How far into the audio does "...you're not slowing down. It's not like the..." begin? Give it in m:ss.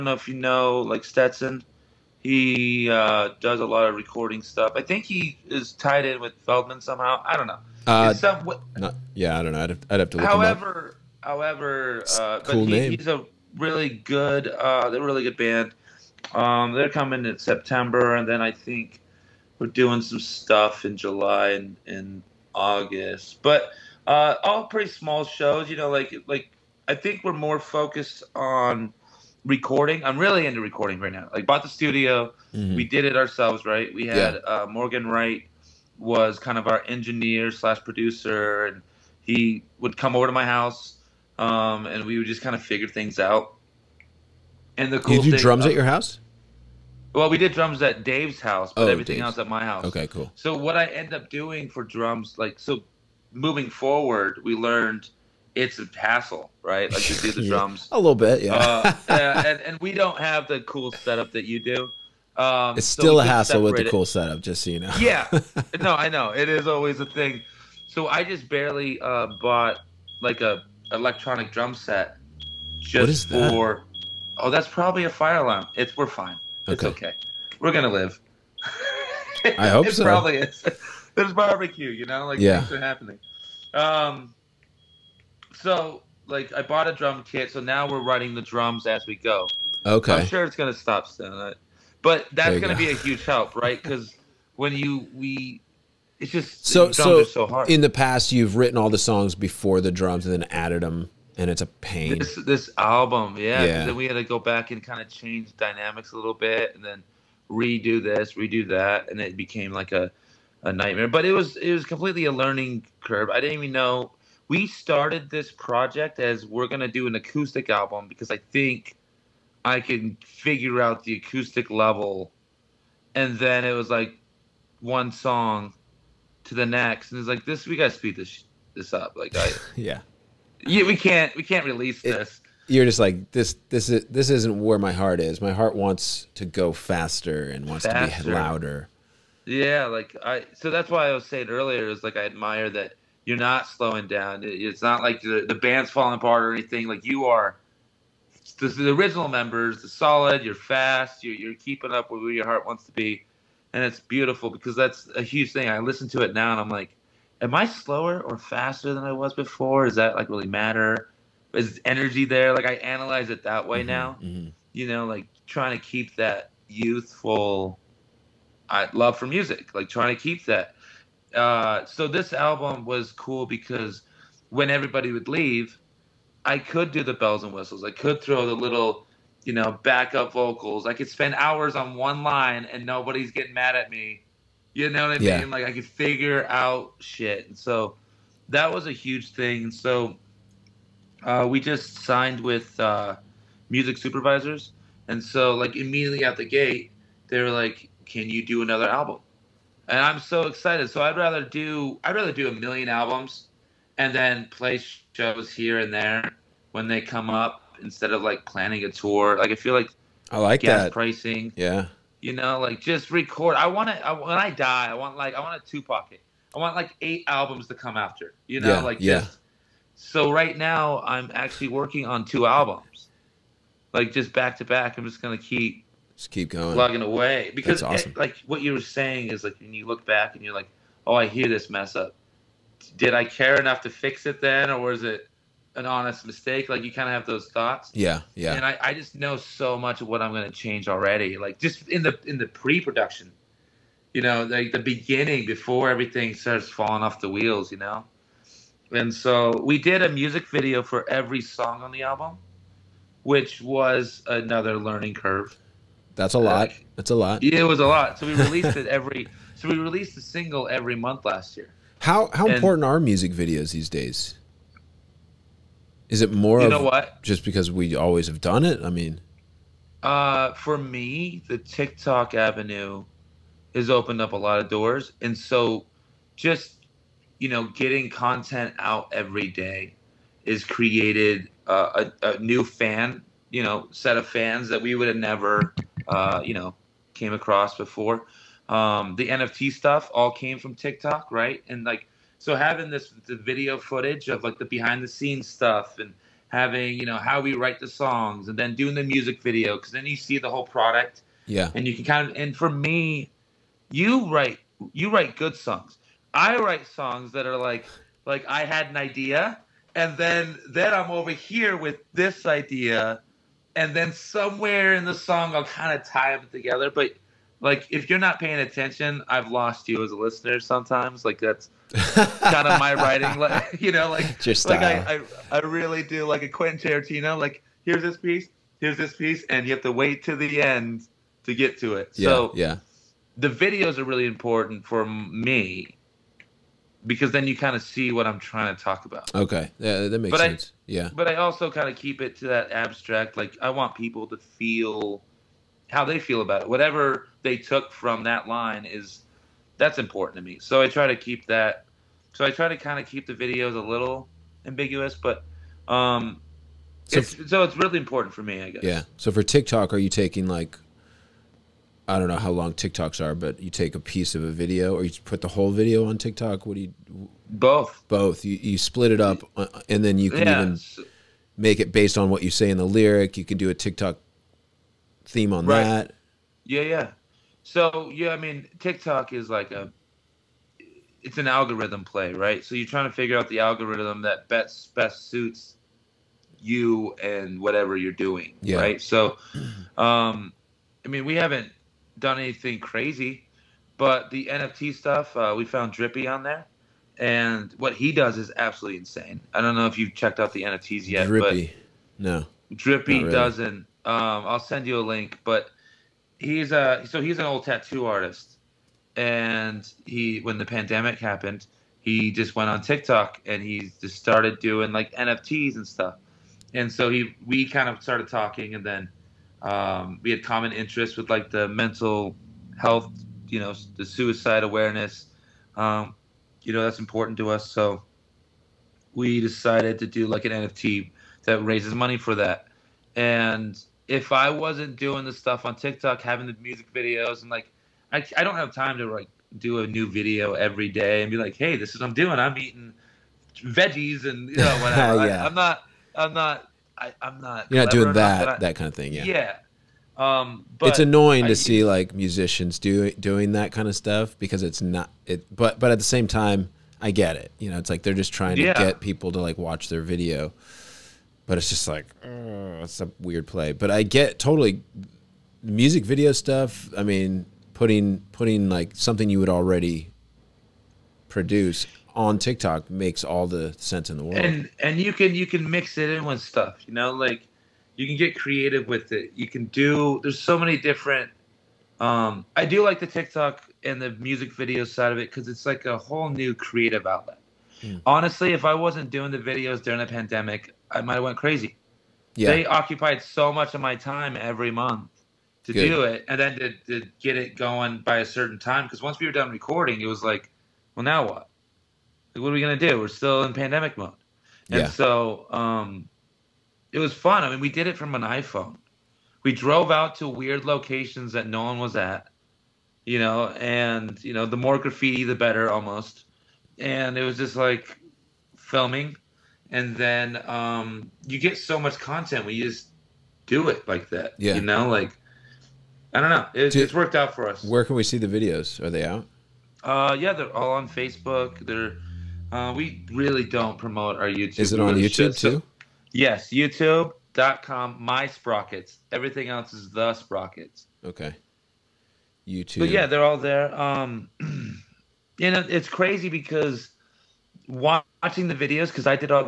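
2:23.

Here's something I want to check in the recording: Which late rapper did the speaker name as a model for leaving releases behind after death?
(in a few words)
Tupac.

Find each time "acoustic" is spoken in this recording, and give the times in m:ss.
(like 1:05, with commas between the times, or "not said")
1:57, 2:01.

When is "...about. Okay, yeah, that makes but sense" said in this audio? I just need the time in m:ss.
5:39.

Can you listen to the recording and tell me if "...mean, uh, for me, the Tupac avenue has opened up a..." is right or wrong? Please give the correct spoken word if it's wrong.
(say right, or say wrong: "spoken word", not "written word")
wrong: "TikTok", not "Tupac".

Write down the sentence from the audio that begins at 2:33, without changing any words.
And it's beautiful because that's a huge thing.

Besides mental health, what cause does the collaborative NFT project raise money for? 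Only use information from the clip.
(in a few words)
suicide awareness.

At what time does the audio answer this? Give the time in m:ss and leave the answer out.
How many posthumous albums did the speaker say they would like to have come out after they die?
3:37.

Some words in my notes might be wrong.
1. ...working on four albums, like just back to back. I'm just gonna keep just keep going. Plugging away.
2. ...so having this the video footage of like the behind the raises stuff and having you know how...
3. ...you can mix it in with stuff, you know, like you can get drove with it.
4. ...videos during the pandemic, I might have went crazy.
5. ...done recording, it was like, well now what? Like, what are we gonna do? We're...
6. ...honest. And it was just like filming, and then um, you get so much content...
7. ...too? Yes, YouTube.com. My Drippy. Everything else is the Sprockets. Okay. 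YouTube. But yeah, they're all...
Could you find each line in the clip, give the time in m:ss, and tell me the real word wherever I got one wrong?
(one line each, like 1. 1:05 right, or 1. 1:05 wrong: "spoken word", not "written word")
1. 3:41 wrong: "two", not "four"
2. 4:52 wrong: "scenes", not "raises"
3. 7:55 wrong: "creative", not "drove"
4. 8:09 right
5. 8:19 right
6. 8:35 wrong: "almost", not "honest"
7. 8:55 wrong: "Sprockets", not "Drippy".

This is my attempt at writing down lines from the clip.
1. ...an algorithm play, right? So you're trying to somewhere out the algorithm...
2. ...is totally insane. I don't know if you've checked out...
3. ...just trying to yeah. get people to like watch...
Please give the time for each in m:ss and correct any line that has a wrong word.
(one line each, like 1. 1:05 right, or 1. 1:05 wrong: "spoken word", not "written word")
1. 6:21 wrong: "figure", not "somewhere"
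2. 6:38 wrong: "absolutely", not "totally"
3. 7:38 right.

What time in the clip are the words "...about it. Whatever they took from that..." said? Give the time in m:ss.
5:46.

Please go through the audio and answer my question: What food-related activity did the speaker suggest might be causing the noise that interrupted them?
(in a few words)
barbecue.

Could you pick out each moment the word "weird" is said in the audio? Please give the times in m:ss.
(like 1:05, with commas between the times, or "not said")
7:43, 8:30.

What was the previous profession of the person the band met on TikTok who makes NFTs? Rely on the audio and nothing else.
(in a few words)
tattoo artist.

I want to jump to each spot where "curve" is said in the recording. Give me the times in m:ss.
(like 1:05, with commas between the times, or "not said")
1:52, 4:15.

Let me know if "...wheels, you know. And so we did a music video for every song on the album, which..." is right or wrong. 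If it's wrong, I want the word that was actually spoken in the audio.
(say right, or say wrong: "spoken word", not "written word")
right.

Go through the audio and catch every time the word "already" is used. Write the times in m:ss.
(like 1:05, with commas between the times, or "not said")
4:00, 7:49.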